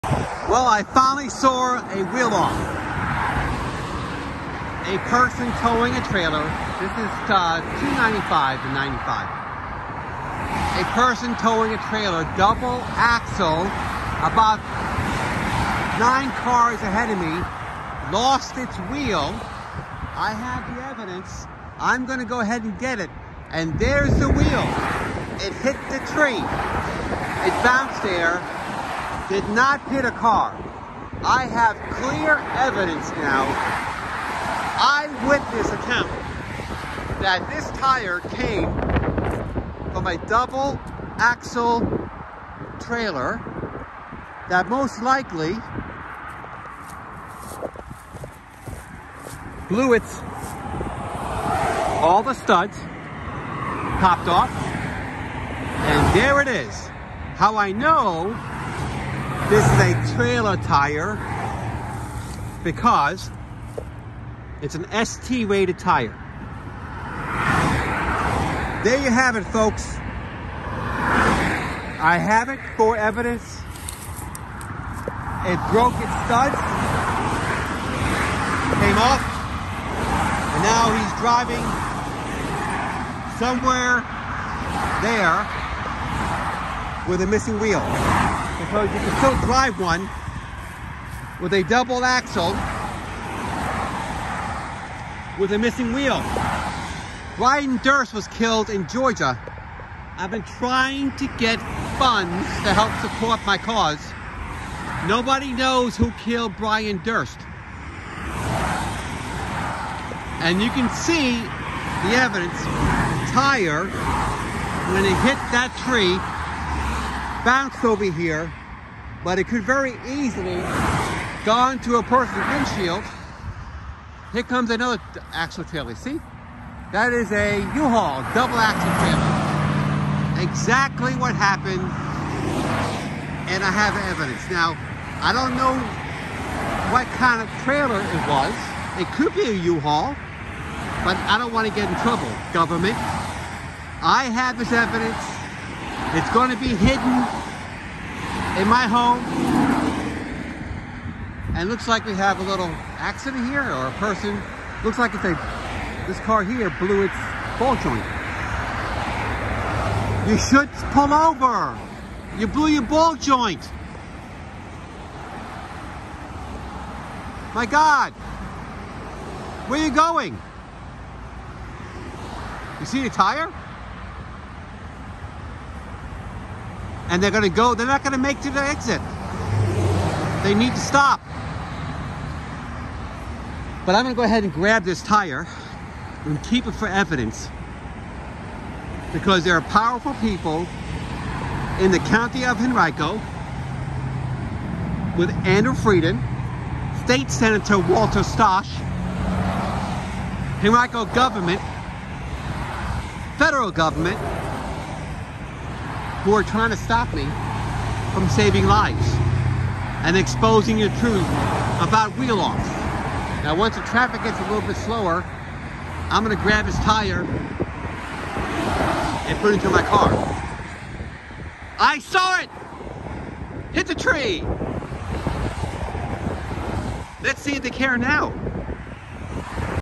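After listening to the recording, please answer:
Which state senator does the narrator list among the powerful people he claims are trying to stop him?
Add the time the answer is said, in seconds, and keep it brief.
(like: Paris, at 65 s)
Walter Stosch, at 197 s.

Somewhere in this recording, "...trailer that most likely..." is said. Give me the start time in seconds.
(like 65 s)
42 s.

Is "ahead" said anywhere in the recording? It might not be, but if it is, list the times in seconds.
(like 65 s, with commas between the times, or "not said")
16 s, 22 s, 184 s.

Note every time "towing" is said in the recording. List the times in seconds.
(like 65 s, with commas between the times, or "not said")
5 s, 11 s.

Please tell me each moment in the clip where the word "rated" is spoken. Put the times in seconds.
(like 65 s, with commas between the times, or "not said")
65 s.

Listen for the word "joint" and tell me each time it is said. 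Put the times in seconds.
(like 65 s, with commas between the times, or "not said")
157 s, 163 s.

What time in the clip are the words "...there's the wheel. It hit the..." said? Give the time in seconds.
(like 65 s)
23 s.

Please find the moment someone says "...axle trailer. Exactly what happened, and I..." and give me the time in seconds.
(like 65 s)
128 s.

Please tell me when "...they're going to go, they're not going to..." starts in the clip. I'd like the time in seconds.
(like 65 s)
177 s.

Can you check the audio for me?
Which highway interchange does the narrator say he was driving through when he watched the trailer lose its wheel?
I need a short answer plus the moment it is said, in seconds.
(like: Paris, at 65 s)
295 to 95, at 7 s.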